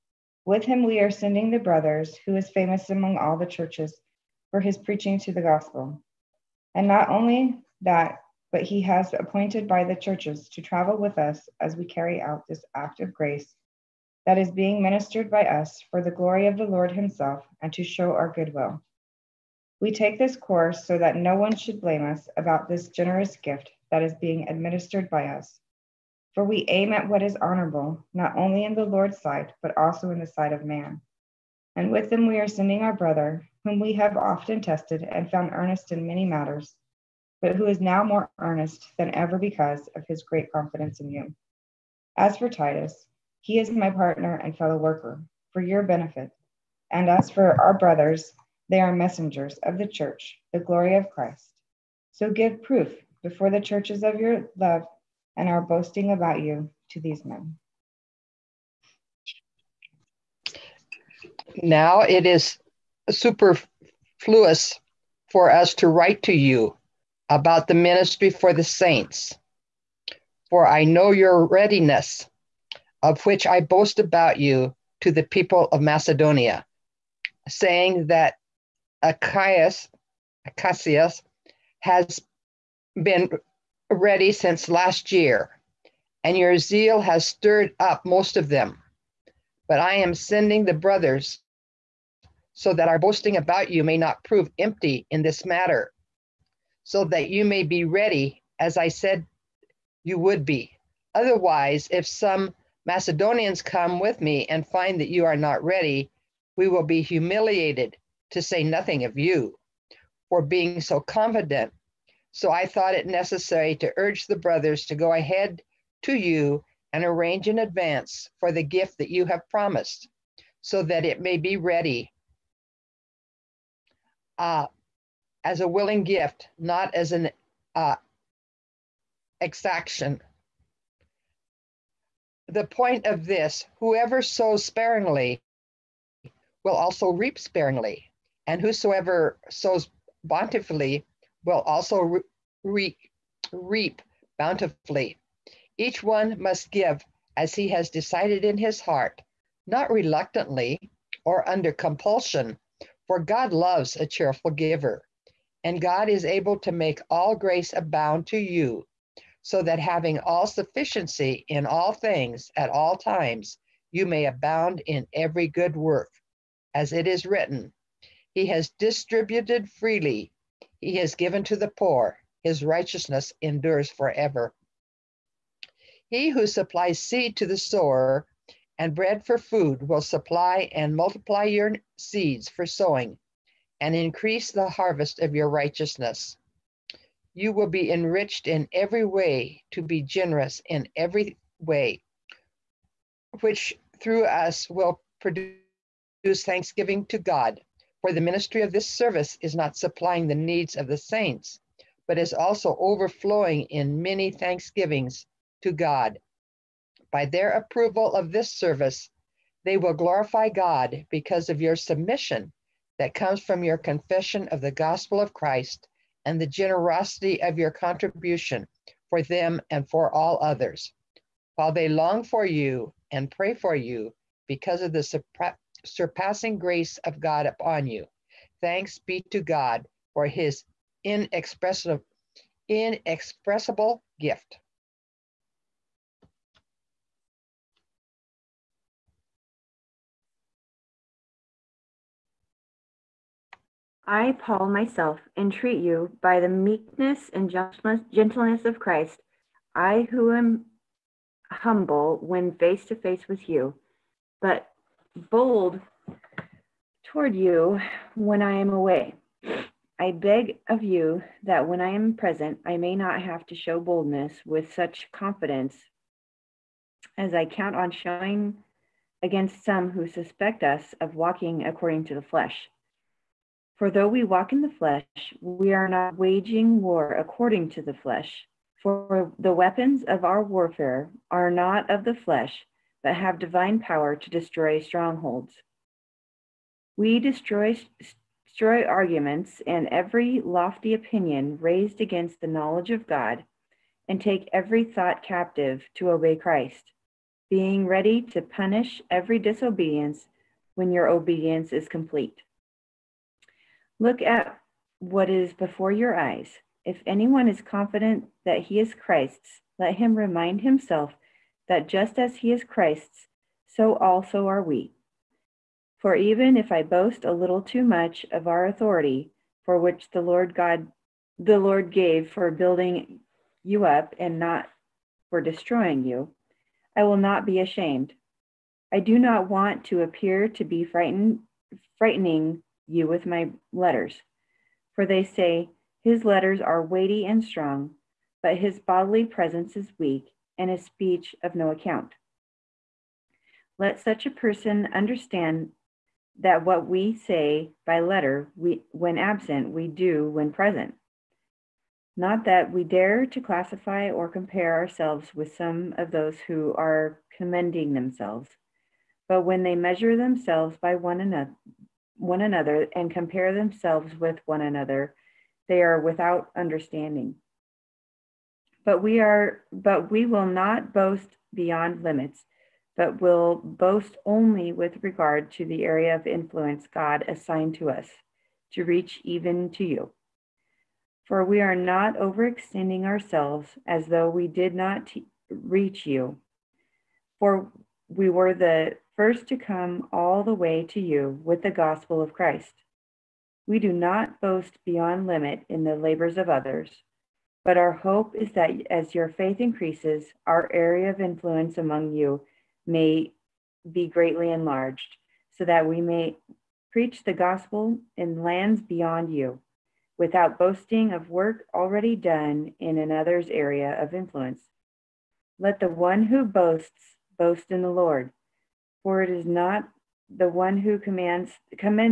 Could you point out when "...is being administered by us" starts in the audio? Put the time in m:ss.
0:24.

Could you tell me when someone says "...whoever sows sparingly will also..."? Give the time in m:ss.
2:13.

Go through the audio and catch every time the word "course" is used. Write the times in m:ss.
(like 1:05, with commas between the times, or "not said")
0:20.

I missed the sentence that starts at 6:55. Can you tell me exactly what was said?
Let the one who boasts boast in the Lord.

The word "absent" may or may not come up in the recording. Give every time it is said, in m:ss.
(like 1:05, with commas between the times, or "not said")
5:49.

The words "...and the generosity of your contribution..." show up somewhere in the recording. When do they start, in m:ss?
3:36.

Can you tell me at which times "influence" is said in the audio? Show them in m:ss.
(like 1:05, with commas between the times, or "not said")
6:16, 6:41, 6:54.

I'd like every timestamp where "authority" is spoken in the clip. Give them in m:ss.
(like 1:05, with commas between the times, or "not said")
5:18.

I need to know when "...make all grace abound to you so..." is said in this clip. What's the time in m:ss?
2:36.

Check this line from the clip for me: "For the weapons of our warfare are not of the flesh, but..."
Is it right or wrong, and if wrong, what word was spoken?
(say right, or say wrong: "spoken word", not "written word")
right.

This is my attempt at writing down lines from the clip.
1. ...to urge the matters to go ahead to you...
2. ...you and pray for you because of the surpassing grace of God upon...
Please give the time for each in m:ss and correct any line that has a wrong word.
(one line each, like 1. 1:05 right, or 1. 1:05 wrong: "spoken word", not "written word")
1. 1:53 wrong: "brothers", not "matters"
2. 3:42 right.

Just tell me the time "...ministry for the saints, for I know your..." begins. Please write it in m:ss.
1:07.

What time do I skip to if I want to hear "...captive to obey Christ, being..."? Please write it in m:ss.
4:55.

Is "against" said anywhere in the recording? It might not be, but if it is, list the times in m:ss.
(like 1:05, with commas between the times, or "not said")
4:29, 4:52.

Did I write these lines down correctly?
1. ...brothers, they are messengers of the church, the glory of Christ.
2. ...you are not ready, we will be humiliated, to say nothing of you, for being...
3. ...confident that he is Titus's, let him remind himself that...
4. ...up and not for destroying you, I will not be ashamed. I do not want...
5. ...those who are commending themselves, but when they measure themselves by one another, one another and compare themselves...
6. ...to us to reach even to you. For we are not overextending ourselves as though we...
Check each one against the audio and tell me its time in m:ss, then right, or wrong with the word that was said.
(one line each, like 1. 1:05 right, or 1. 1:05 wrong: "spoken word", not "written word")
1. 0:47 right
2. 1:45 right
3. 5:07 wrong: "Christ", not "Titus"
4. 5:23 right
5. 5:56 right
6. 6:17 right.